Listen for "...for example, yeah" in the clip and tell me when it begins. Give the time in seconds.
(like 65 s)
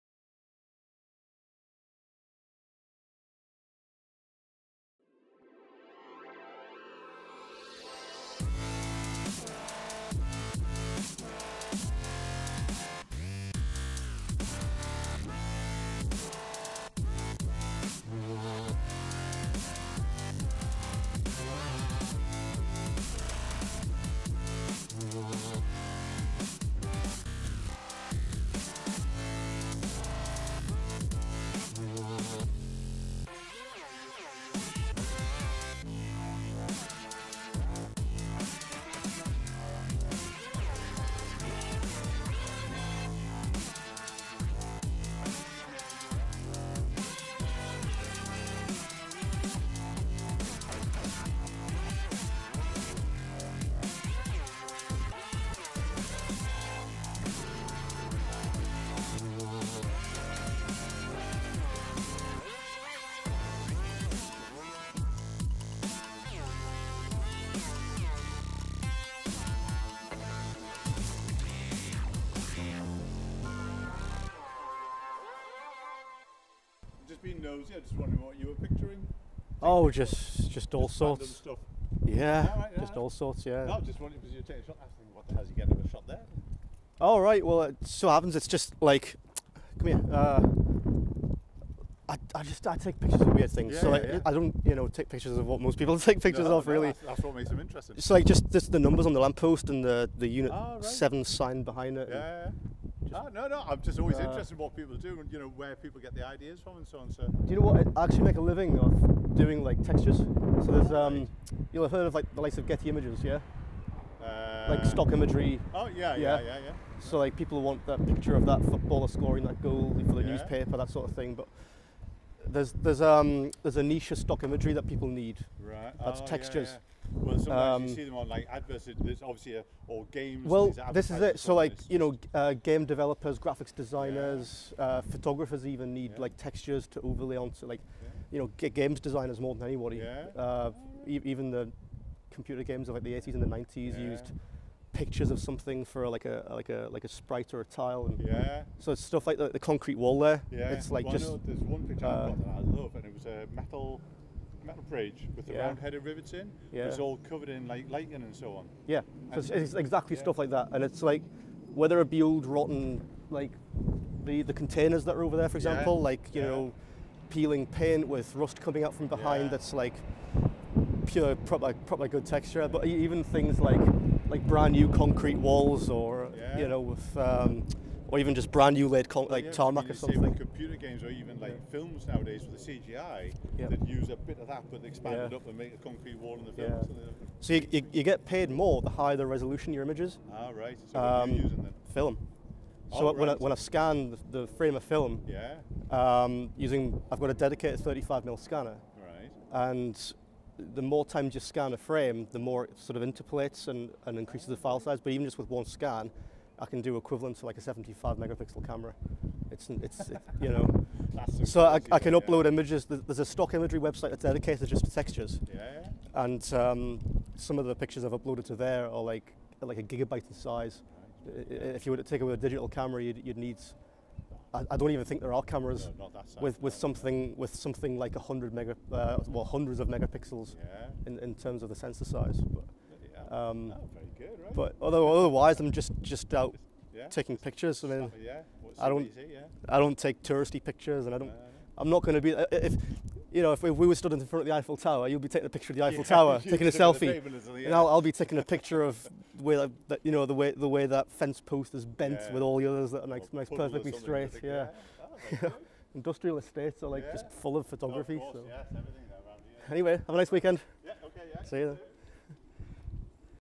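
165 s.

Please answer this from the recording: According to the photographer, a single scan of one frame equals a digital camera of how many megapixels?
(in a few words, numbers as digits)
75.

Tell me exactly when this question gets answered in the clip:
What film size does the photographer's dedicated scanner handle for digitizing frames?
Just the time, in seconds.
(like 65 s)
197 s.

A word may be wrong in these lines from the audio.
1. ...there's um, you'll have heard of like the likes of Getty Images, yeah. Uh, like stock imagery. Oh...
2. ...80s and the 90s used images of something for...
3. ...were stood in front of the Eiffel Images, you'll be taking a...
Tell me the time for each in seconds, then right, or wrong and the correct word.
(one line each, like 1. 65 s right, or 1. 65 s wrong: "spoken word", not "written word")
1. 110 s right
2. 143 s wrong: "pictures", not "images"
3. 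243 s wrong: "Tower", not "Images".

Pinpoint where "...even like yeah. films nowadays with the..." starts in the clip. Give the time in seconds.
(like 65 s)
181 s.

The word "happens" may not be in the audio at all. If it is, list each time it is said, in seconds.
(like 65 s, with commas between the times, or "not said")
88 s.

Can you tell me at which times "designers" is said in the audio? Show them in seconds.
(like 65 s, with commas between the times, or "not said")
133 s, 138 s.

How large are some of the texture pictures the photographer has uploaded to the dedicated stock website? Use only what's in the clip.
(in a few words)
a gigabyte.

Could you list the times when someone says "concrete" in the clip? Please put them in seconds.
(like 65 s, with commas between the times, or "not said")
149 s, 174 s, 185 s.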